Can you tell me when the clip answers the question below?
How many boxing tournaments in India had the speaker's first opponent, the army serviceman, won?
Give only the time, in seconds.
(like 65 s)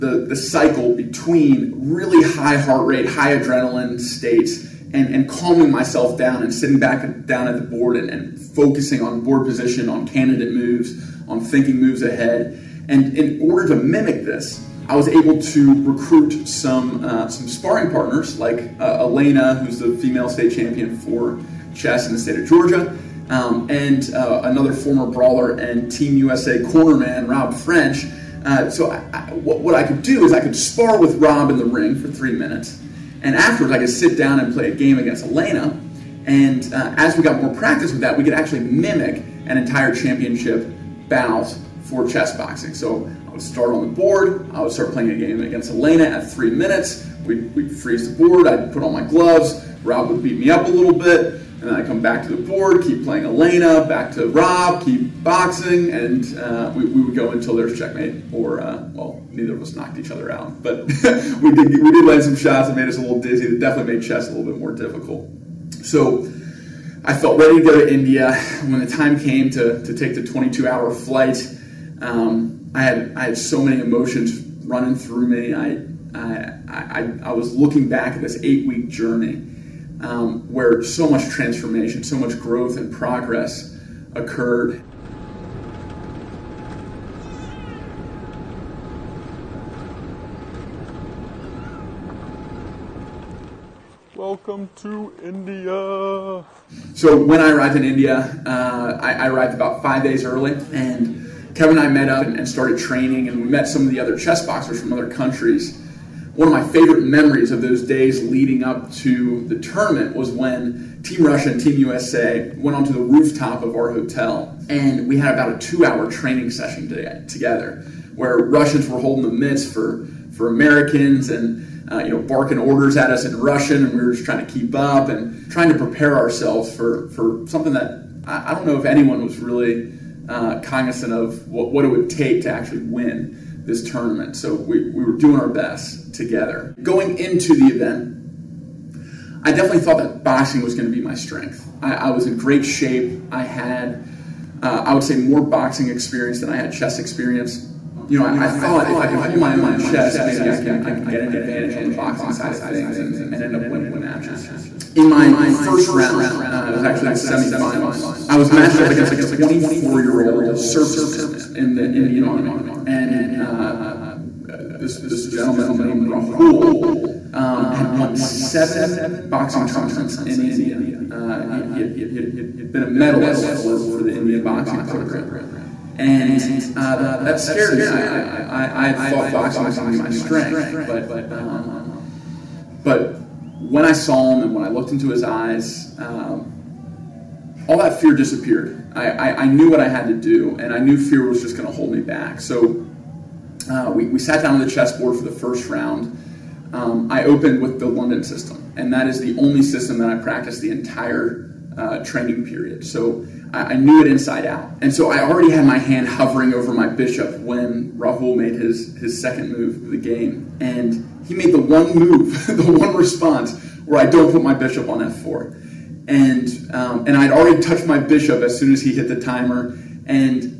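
168 s.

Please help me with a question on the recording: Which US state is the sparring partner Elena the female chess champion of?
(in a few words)
Georgia.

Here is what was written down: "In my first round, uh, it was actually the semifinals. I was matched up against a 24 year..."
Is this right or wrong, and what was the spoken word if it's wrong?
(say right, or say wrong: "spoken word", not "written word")
right.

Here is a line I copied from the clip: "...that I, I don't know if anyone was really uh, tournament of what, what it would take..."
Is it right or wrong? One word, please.
wrong.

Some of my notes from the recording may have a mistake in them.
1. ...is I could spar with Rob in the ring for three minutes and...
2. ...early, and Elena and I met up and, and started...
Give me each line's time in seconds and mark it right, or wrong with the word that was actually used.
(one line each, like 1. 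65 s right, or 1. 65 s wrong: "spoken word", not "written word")
1. 30 s right
2. 100 s wrong: "Kevin", not "Elena".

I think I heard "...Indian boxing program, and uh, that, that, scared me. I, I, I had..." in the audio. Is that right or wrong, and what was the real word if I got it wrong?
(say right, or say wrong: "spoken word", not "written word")
right.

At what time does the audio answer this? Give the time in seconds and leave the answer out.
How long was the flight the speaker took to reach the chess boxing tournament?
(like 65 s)
70 s.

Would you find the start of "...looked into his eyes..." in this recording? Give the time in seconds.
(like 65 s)
184 s.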